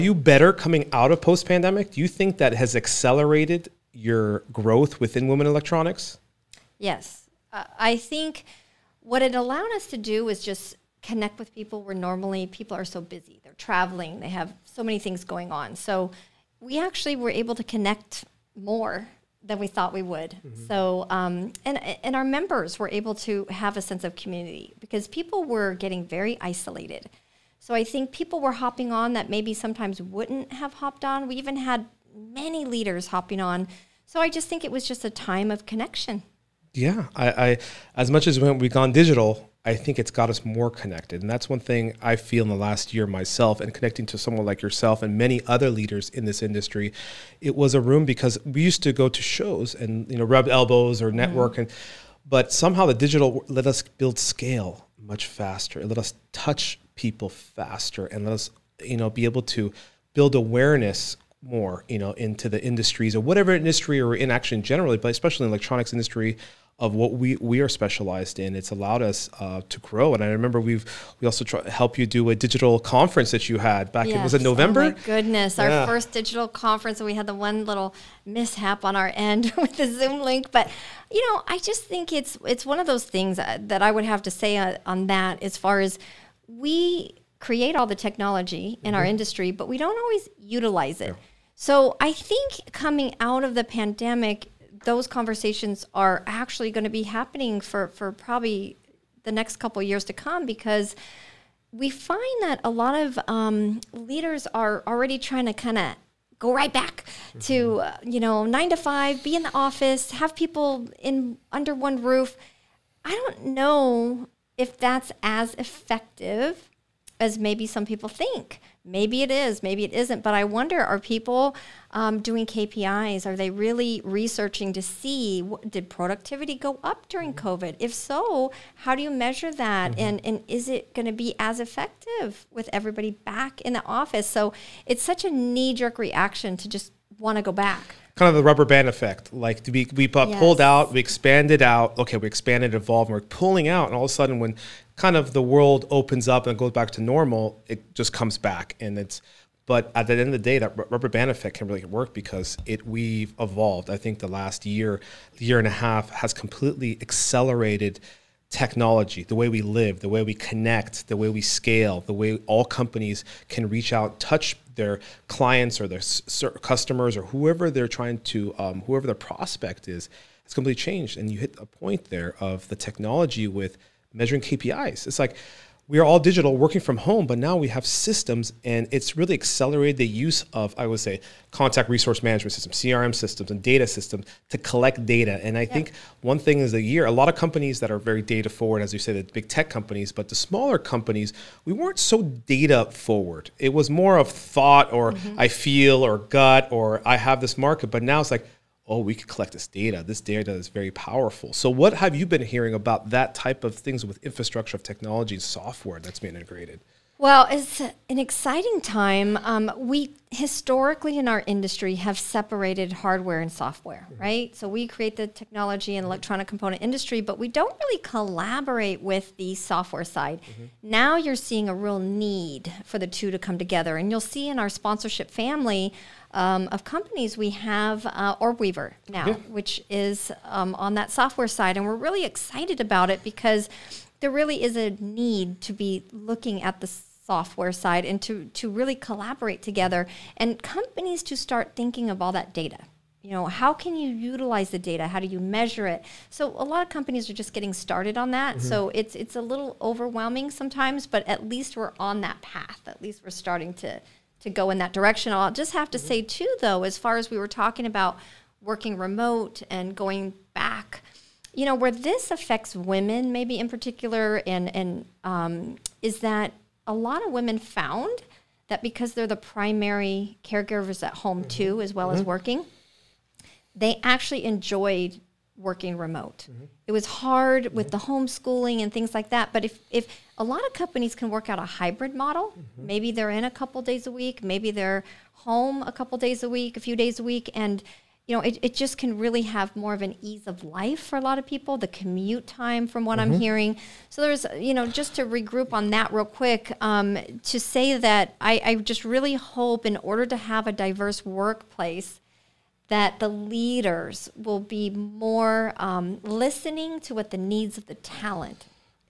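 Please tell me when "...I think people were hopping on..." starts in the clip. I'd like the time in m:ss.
0:27.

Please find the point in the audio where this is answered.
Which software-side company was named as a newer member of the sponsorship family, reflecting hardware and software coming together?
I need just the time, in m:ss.
3:48.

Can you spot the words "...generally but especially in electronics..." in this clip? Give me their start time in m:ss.
1:04.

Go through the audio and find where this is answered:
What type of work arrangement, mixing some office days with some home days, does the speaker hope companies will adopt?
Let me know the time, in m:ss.
4:41.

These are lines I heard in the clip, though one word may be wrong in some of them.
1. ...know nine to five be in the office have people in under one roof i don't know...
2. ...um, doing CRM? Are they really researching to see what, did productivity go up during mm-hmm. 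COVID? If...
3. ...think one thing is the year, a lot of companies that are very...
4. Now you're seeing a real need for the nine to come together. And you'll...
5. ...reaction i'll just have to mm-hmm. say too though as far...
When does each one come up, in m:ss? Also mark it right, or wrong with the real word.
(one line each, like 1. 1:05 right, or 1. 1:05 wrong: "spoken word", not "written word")
1. 1:48 right
2. 2:01 wrong: "KPIs", not "CRM"
3. 3:05 right
4. 3:40 wrong: "two", not "nine"
5. 4:14 wrong: "direction", not "reaction".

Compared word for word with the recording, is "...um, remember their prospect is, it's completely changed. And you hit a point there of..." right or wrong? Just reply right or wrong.
wrong.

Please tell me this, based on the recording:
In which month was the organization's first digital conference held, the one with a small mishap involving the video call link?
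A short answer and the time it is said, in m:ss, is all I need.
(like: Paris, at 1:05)
November, at 1:14.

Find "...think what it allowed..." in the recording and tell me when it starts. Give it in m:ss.
0:07.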